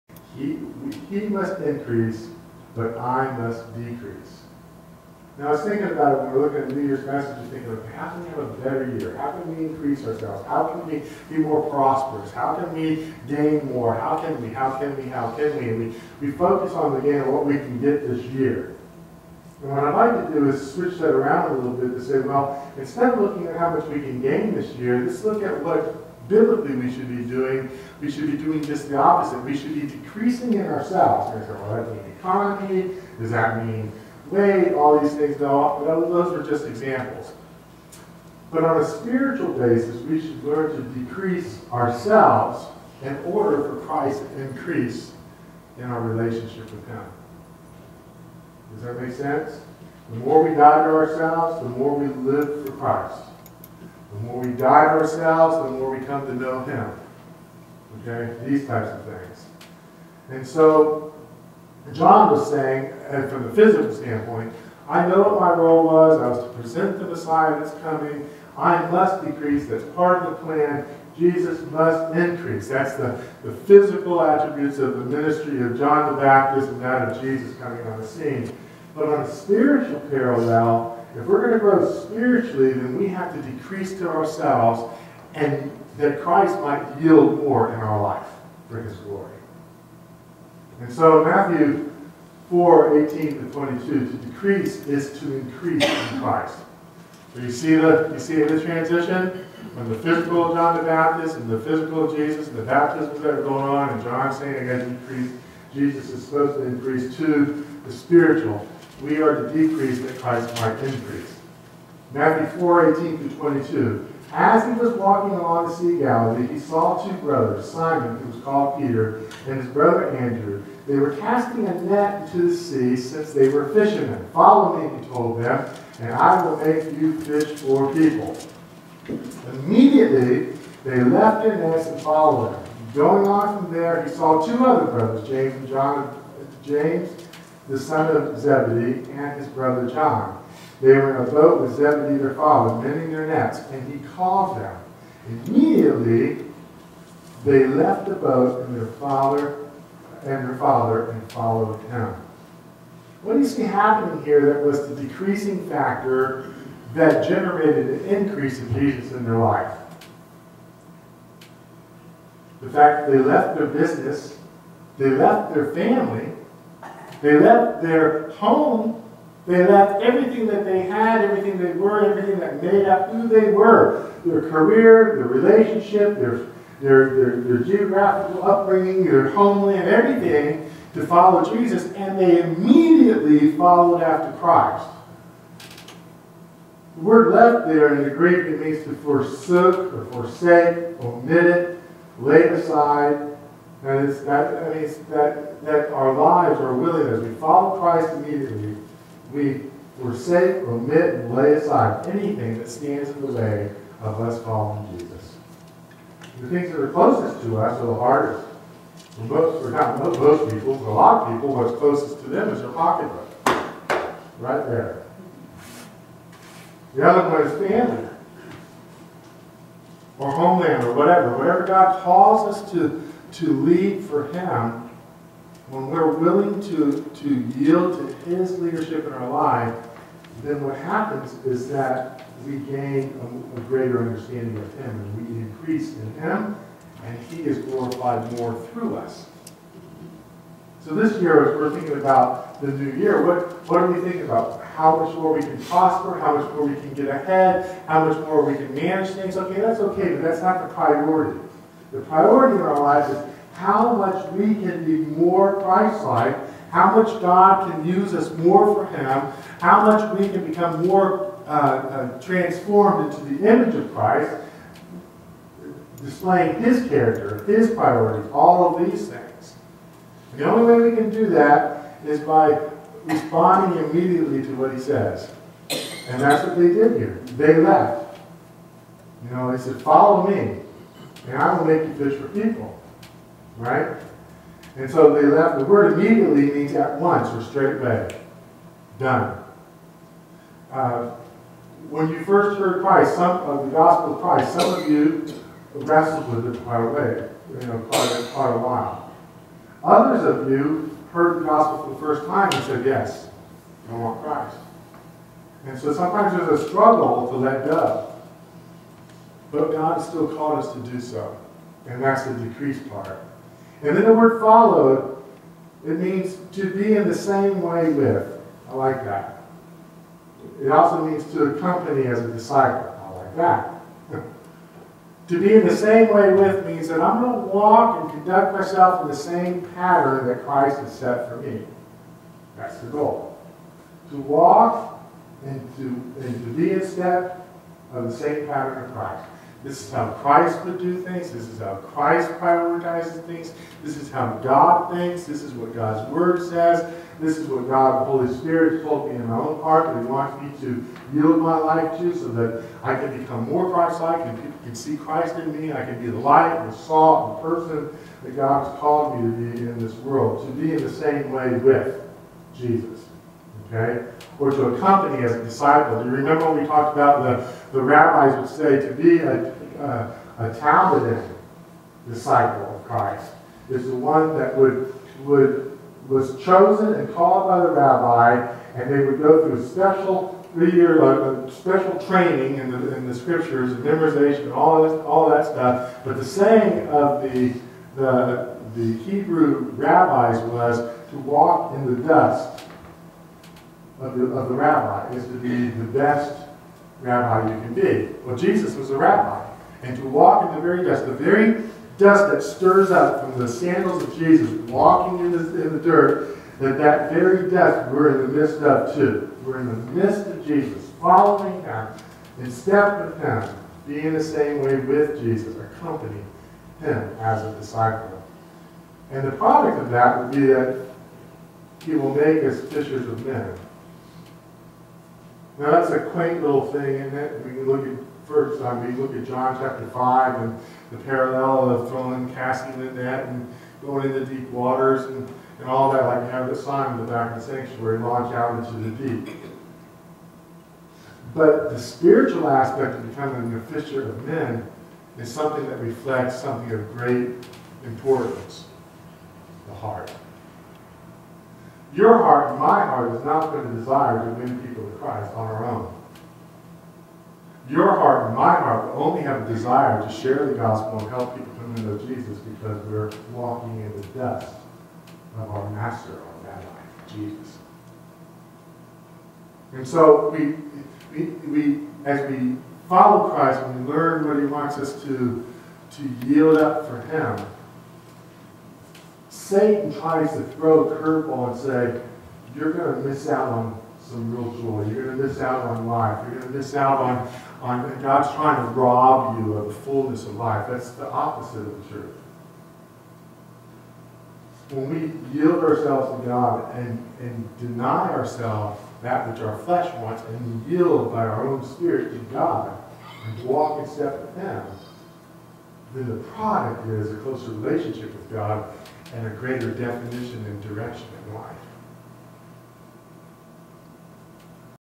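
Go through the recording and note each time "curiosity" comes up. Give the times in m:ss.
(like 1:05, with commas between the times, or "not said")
not said.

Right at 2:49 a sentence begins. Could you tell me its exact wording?
They left everything that they had, everything they were, everything that made up who they were.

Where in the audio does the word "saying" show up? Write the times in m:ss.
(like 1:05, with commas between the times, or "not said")
1:02, 1:44, 6:26.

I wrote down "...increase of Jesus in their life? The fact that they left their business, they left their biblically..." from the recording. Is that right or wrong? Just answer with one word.
wrong.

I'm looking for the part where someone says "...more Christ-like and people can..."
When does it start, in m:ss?
5:53.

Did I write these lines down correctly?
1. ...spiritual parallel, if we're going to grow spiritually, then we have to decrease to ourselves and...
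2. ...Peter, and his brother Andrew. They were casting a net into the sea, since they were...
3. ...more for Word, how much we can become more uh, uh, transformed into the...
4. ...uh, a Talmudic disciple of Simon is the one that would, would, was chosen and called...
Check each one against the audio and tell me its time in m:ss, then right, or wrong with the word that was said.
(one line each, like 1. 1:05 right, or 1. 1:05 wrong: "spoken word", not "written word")
1. 1:19 right
2. 1:58 right
3. 4:18 wrong: "Him", not "Word"
4. 6:09 wrong: "Christ", not "Simon".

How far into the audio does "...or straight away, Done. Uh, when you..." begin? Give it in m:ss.
4:47.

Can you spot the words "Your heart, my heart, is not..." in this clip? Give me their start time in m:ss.
7:31.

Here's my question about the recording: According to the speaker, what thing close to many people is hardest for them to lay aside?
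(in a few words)
Their pocketbook.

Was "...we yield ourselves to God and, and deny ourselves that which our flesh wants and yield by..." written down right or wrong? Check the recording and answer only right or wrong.
right.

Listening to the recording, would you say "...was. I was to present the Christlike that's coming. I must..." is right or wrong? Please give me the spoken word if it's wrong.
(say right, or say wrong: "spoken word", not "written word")
wrong: "Messiah", not "Christlike".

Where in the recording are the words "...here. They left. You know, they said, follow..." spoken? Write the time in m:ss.
4:36.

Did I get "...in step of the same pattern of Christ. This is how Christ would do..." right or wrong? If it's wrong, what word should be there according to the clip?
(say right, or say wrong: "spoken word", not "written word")
right.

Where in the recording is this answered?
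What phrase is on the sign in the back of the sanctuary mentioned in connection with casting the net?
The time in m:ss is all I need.
7:17.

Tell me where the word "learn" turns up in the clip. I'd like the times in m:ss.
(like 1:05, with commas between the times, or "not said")
0:40, 7:53.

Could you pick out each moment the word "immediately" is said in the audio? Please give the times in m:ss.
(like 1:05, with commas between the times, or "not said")
2:09, 2:25, 3:02, 3:18, 4:33, 4:45.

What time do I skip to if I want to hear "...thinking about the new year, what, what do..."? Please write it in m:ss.
4:01.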